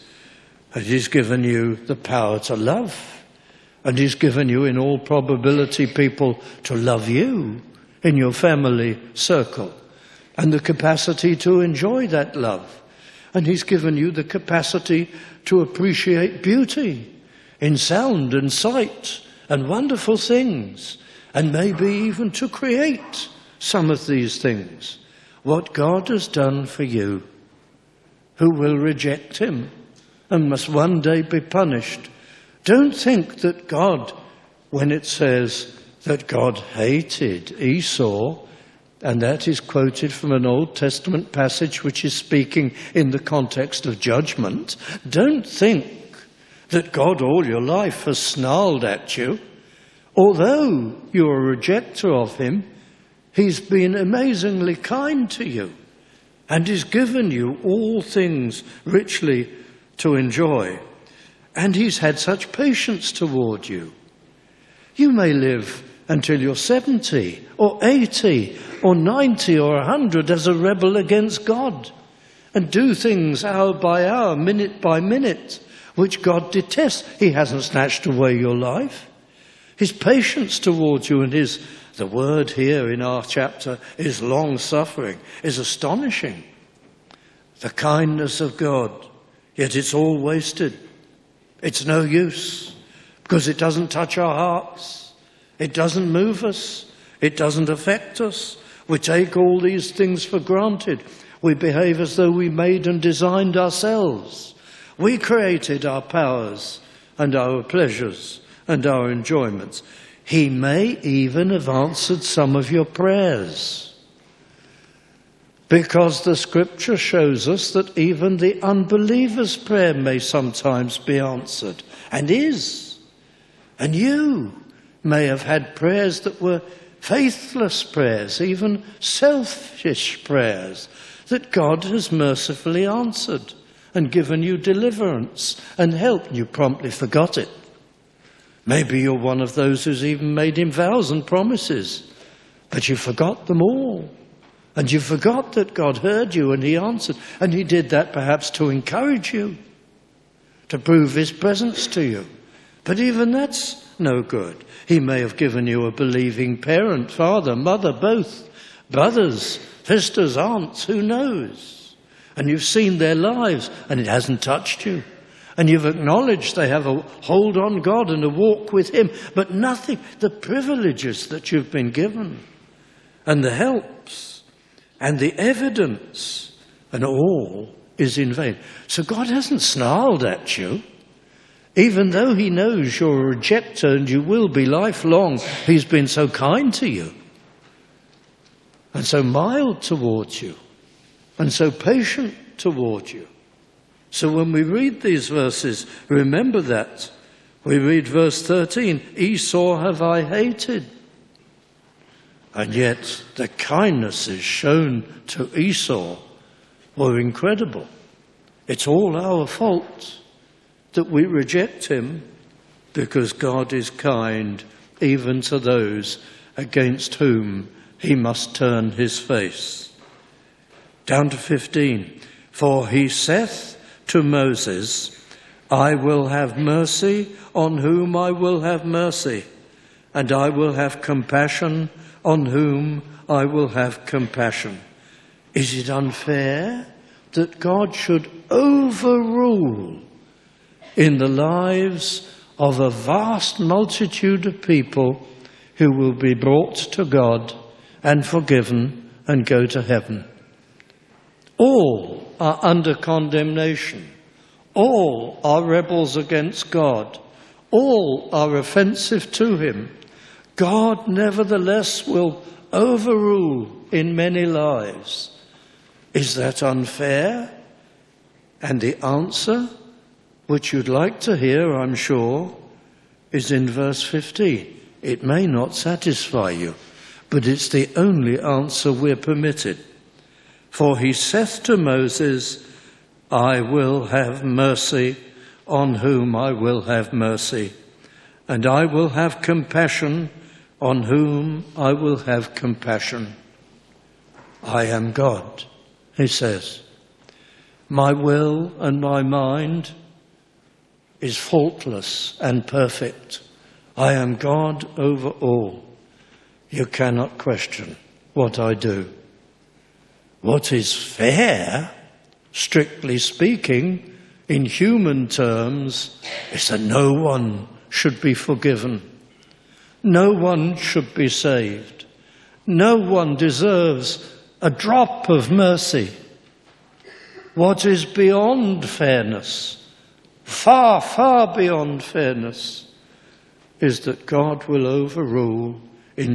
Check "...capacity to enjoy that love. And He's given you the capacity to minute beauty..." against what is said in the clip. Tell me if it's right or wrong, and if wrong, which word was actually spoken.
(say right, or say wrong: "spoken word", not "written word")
wrong: "appreciate", not "minute".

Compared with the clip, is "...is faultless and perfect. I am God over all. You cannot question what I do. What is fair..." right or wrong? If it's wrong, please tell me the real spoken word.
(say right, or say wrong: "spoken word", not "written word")
right.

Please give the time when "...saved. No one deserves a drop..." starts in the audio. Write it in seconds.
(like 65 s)
321 s.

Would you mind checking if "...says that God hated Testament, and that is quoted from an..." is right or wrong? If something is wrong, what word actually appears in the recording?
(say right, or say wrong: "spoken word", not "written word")
wrong: "Esau", not "Testament".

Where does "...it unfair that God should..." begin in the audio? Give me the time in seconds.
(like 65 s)
235 s.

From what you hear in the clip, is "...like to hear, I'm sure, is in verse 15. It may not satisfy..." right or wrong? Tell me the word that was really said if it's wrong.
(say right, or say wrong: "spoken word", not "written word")
right.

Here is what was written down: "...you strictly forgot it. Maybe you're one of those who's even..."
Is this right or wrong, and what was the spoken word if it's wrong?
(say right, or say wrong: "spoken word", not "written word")
wrong: "promptly", not "strictly".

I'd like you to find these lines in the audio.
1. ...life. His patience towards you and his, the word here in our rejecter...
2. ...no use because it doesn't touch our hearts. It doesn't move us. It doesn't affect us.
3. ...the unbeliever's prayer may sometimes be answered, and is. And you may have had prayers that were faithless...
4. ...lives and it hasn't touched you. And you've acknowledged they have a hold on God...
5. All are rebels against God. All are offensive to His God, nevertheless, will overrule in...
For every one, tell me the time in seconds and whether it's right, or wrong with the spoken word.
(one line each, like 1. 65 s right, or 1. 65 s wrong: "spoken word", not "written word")
1. 78 s wrong: "chapter", not "rejecter"
2. 91 s right
3. 118 s right
4. 163 s right
5. 254 s wrong: "Him", not "His".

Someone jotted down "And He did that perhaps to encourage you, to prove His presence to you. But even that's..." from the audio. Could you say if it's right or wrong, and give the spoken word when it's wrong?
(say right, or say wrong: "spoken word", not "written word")
right.